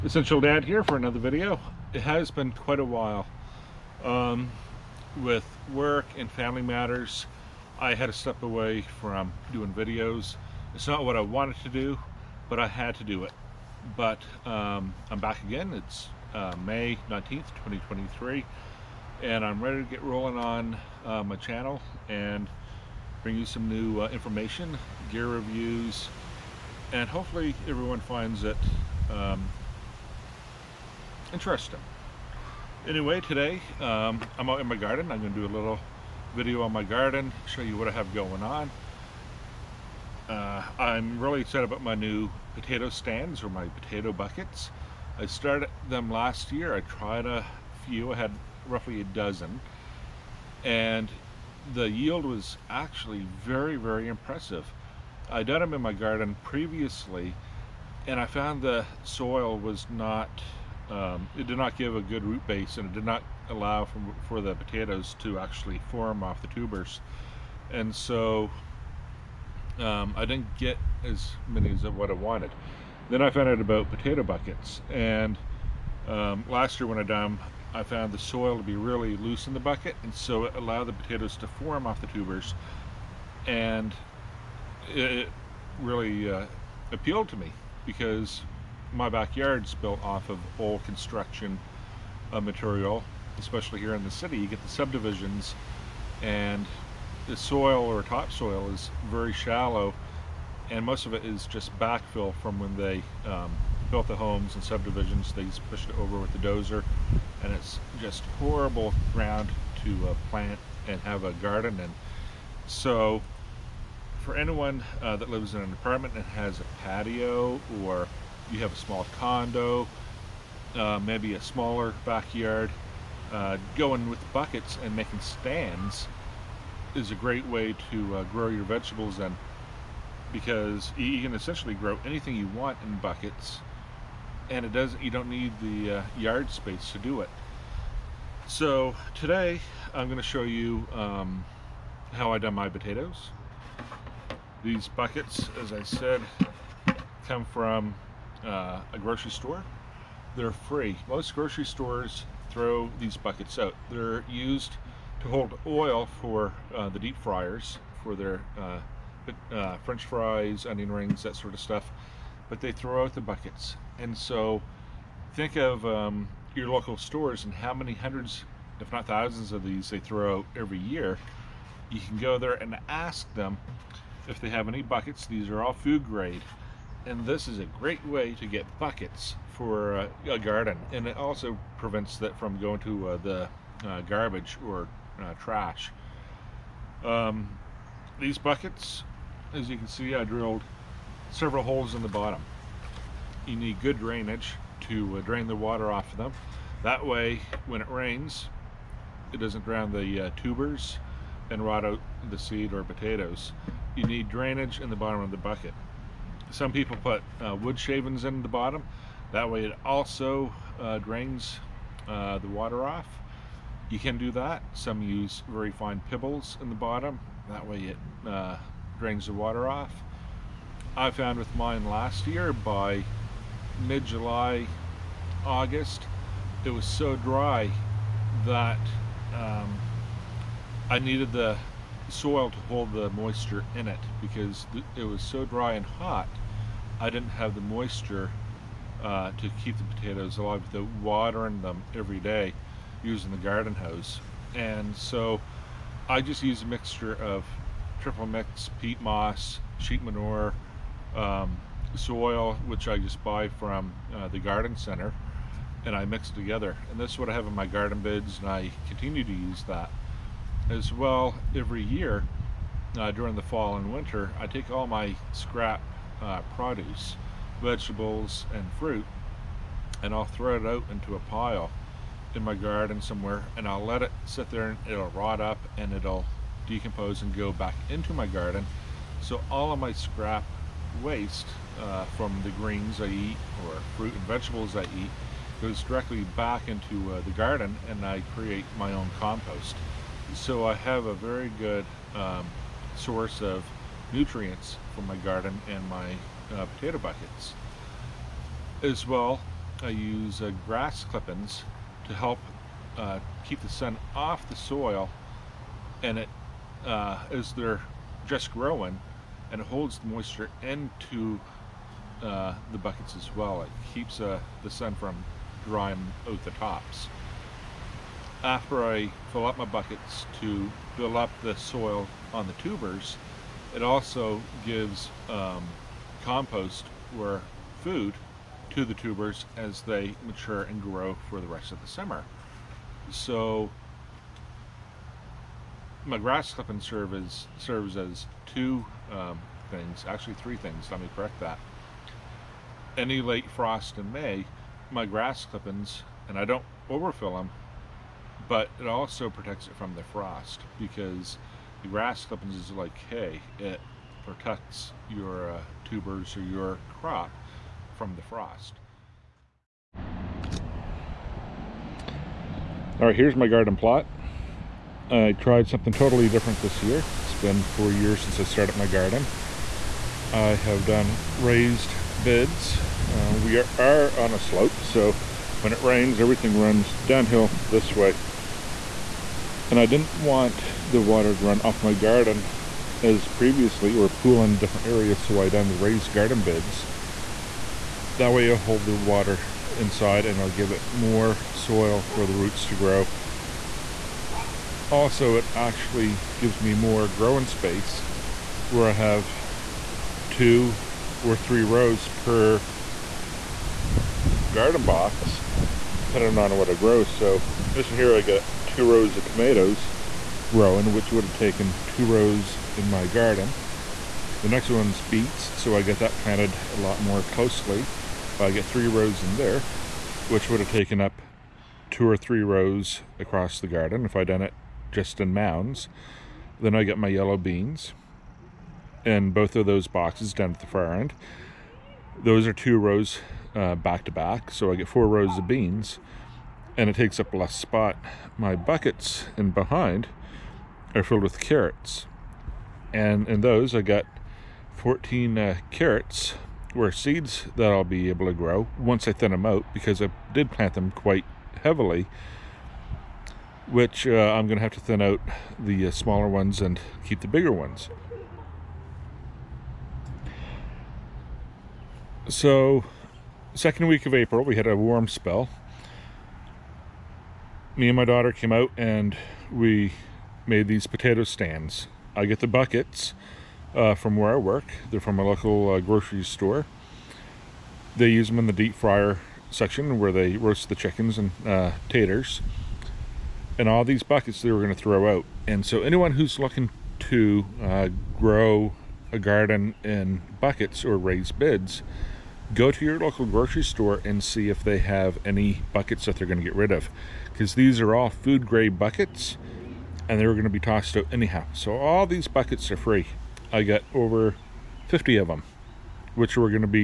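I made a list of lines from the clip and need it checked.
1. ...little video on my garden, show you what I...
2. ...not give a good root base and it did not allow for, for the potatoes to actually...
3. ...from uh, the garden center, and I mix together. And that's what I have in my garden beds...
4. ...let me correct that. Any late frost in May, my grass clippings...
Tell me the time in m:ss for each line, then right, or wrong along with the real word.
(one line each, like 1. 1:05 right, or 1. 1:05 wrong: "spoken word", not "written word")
1. 0:35 right
2. 1:01 right
3. 4:13 right
4. 5:40 right.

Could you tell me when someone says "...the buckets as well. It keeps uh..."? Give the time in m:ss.
5:12.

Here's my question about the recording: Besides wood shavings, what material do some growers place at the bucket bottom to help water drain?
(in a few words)
very fine pebbles.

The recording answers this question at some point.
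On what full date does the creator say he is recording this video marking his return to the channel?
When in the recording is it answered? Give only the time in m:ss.
0:16.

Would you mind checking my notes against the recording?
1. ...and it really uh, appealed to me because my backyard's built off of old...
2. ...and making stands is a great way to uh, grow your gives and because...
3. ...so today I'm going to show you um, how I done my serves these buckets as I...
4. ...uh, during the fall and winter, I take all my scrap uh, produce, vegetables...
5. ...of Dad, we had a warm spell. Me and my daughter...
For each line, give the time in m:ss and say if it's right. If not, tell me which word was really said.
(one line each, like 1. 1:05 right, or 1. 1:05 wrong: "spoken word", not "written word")
1. 1:23 right
2. 2:04 wrong: "vegetables", not "gives"
3. 2:18 wrong: "potatoes", not "serves"
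4. 4:22 right
5. 7:44 wrong: "April", not "Dad".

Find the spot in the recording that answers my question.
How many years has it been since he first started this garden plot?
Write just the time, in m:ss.
6:07.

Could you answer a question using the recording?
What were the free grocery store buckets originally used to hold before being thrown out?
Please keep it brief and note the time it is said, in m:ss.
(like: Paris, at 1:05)
oil, at 2:35.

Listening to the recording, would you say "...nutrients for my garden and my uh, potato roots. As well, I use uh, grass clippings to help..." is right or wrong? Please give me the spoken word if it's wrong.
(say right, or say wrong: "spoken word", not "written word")
wrong: "buckets", not "roots".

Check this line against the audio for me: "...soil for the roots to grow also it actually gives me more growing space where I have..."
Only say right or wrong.
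right.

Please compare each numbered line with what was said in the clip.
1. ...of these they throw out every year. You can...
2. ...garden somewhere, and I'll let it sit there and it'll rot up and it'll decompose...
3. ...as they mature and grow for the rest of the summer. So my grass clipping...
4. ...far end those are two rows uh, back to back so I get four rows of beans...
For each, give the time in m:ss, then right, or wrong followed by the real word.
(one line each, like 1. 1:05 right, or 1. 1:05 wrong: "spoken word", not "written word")
1. 2:49 right
2. 4:32 right
3. 5:29 right
4. 7:10 right.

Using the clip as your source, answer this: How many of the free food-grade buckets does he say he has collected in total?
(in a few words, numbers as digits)
over 50.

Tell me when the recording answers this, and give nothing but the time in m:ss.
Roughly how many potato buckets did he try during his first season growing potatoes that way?
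0:48.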